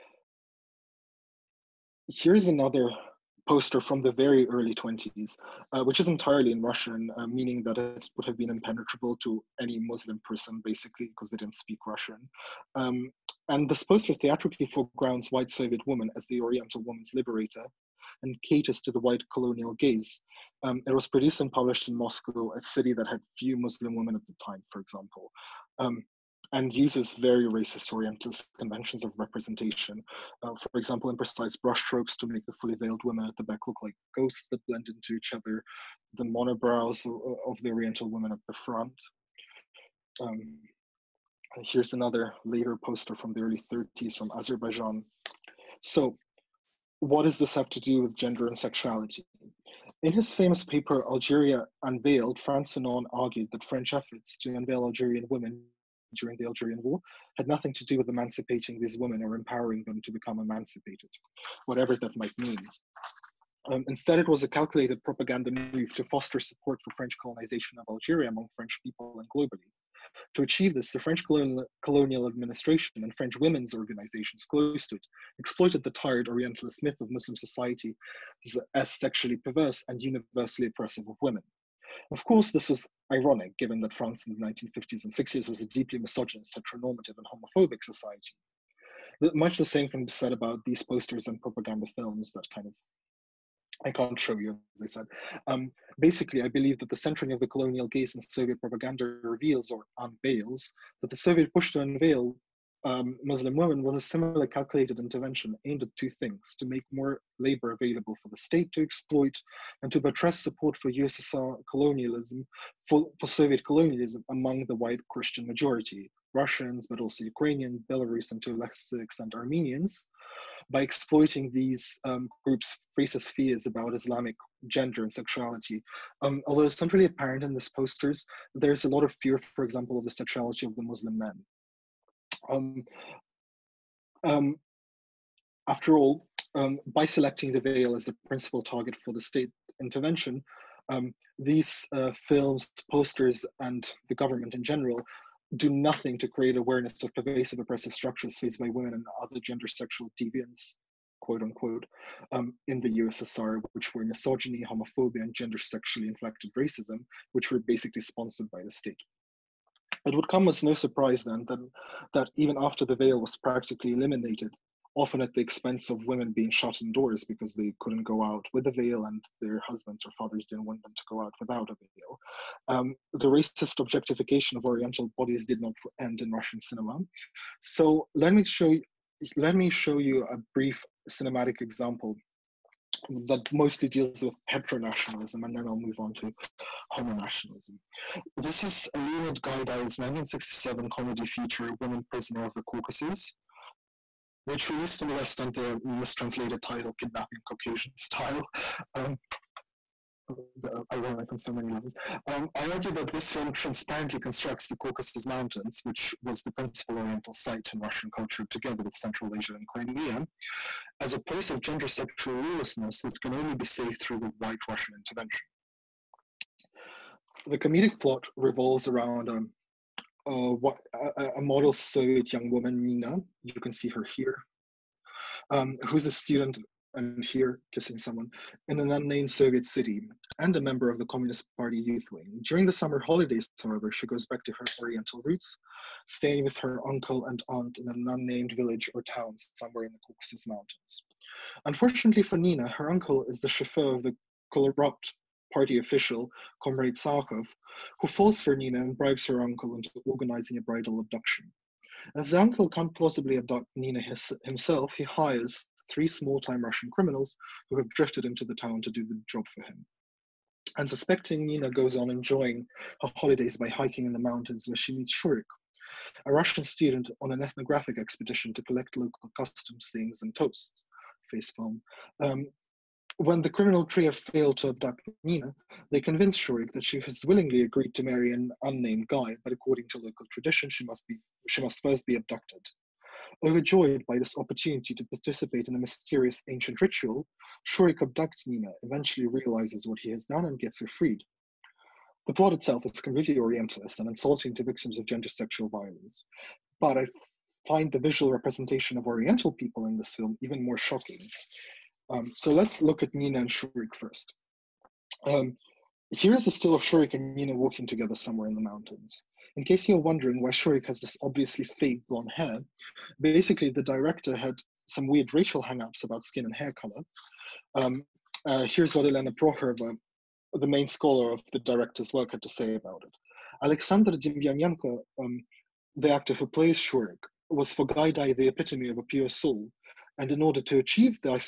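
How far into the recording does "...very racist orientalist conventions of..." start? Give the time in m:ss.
0:27.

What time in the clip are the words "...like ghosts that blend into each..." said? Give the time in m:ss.
0:33.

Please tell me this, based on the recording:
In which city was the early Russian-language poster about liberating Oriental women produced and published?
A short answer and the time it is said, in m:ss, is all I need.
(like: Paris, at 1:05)
Moscow, at 0:21.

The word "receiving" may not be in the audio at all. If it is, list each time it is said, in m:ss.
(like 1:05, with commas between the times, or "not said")
not said.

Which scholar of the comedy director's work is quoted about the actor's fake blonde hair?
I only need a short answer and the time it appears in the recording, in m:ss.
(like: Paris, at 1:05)
Elena Prokhorova, at 5:19.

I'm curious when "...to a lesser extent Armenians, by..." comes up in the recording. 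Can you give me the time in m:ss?
1:58.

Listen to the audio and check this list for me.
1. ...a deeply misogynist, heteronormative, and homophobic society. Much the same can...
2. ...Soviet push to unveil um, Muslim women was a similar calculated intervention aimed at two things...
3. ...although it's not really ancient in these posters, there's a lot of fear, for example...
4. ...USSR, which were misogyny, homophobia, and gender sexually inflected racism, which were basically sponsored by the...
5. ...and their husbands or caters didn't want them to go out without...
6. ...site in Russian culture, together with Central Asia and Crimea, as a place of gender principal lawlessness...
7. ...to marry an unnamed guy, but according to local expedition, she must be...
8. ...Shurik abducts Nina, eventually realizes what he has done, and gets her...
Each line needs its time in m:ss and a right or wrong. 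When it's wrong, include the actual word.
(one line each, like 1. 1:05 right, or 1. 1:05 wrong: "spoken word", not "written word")
1. 1:25 right
2. 1:41 right
3. 2:06 wrong: "apparent", not "ancient"
4. 2:32 right
5. 2:49 wrong: "fathers", not "caters"
6. 3:27 wrong: "sexual", not "principal"
7. 4:37 wrong: "tradition", not "expedition"
8. 4:47 right.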